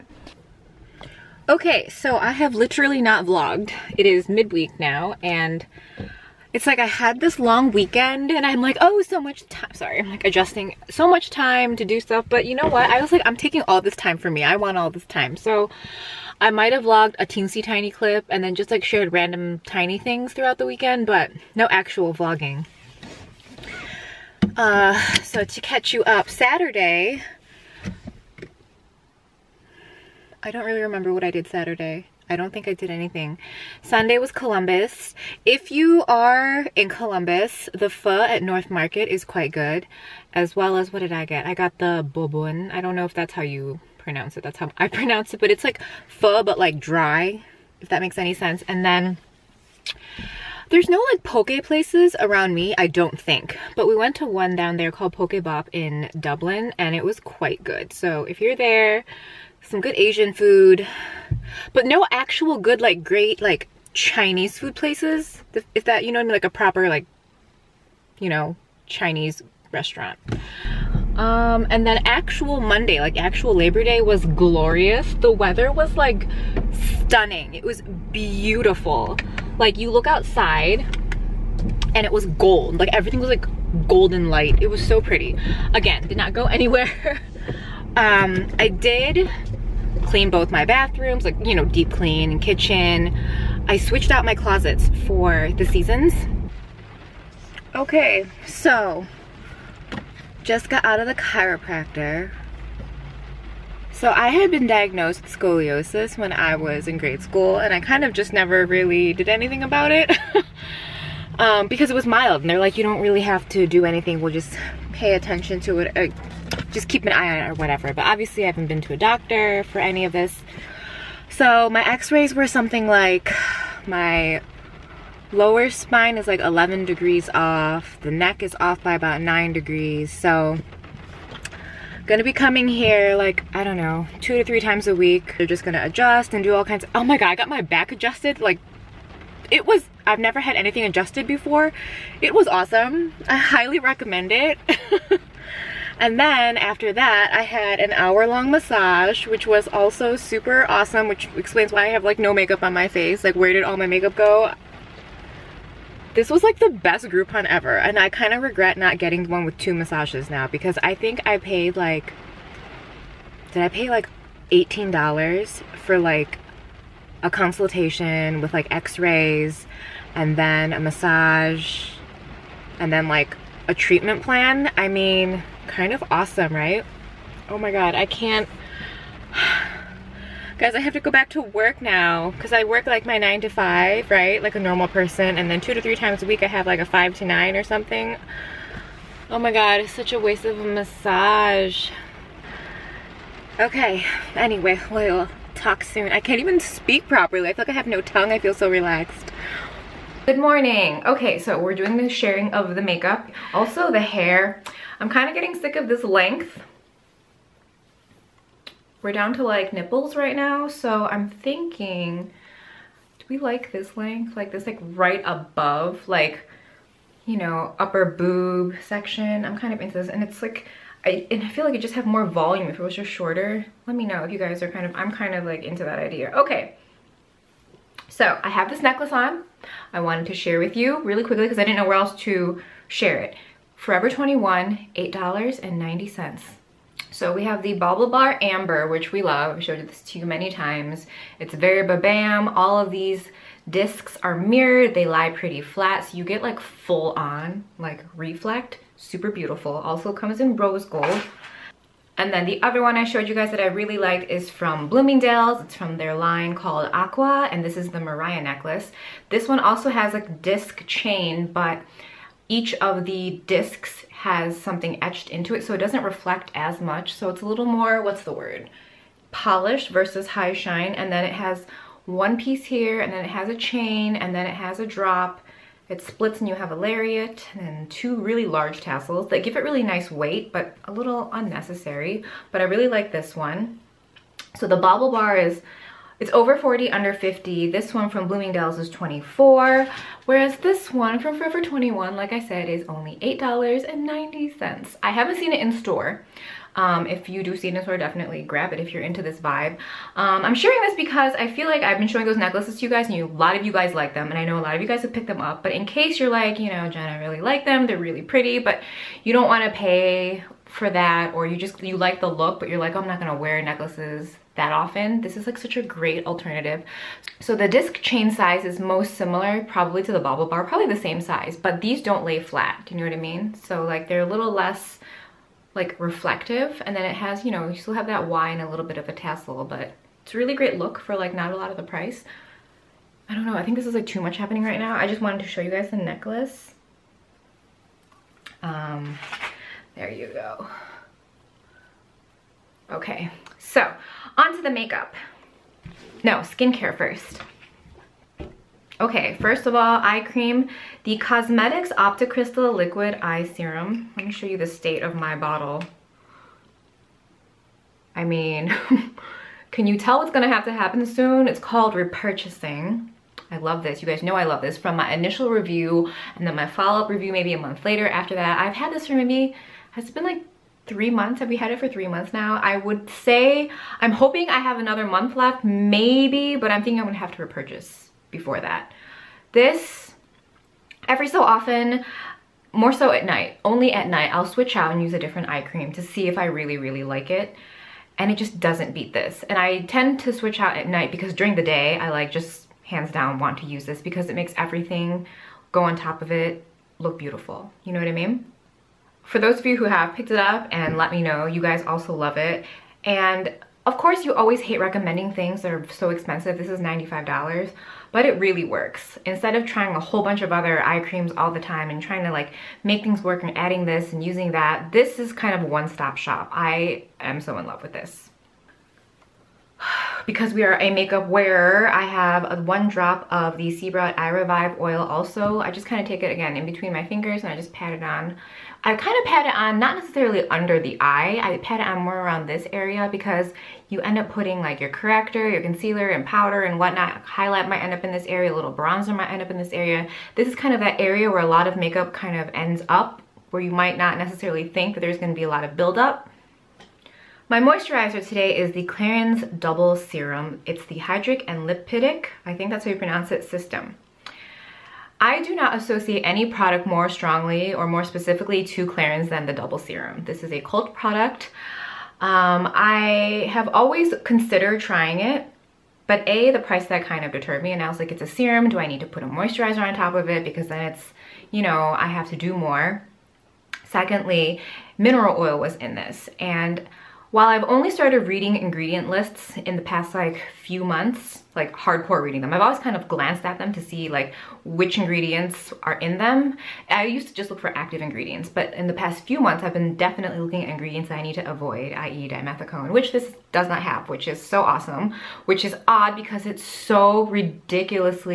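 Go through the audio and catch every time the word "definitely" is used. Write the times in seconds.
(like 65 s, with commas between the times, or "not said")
297 s, 489 s.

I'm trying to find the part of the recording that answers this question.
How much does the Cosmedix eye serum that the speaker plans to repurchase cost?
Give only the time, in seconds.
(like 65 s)
406 s.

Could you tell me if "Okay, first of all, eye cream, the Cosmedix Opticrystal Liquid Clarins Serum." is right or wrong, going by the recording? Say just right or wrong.
wrong.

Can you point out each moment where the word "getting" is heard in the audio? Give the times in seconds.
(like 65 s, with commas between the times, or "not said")
158 s, 205 s.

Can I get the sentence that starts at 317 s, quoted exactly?
So the disc chain size is most similar probably to the Baublebar, probably the same size, but these don't lay flat.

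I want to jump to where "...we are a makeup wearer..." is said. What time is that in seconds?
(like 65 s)
420 s.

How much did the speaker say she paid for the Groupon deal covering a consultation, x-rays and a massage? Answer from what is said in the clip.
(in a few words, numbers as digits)
$18.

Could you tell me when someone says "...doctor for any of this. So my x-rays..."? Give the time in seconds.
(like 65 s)
118 s.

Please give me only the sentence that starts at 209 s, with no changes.
We're down to like nipples right now, so I'm thinking, do we like this length?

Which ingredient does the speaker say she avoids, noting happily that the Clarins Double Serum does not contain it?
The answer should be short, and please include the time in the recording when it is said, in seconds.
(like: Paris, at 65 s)
dimethicone, at 492 s.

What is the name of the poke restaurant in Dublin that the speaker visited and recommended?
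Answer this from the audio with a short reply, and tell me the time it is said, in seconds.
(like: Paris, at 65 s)
Poke Bop, at 55 s.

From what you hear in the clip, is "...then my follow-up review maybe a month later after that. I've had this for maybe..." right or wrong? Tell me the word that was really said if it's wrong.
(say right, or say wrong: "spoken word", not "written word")
right.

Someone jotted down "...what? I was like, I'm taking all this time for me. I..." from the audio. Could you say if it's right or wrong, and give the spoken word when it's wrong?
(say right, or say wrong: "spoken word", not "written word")
right.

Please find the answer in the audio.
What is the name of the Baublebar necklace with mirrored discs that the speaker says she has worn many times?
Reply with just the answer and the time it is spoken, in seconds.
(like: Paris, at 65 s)
Amber, at 238 s.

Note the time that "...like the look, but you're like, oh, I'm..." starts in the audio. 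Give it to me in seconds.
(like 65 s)
311 s.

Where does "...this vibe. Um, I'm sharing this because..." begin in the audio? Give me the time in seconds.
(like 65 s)
299 s.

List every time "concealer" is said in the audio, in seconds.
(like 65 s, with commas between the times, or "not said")
435 s.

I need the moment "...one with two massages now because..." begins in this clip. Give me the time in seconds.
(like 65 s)
159 s.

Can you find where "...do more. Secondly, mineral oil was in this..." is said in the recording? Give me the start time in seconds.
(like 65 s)
472 s.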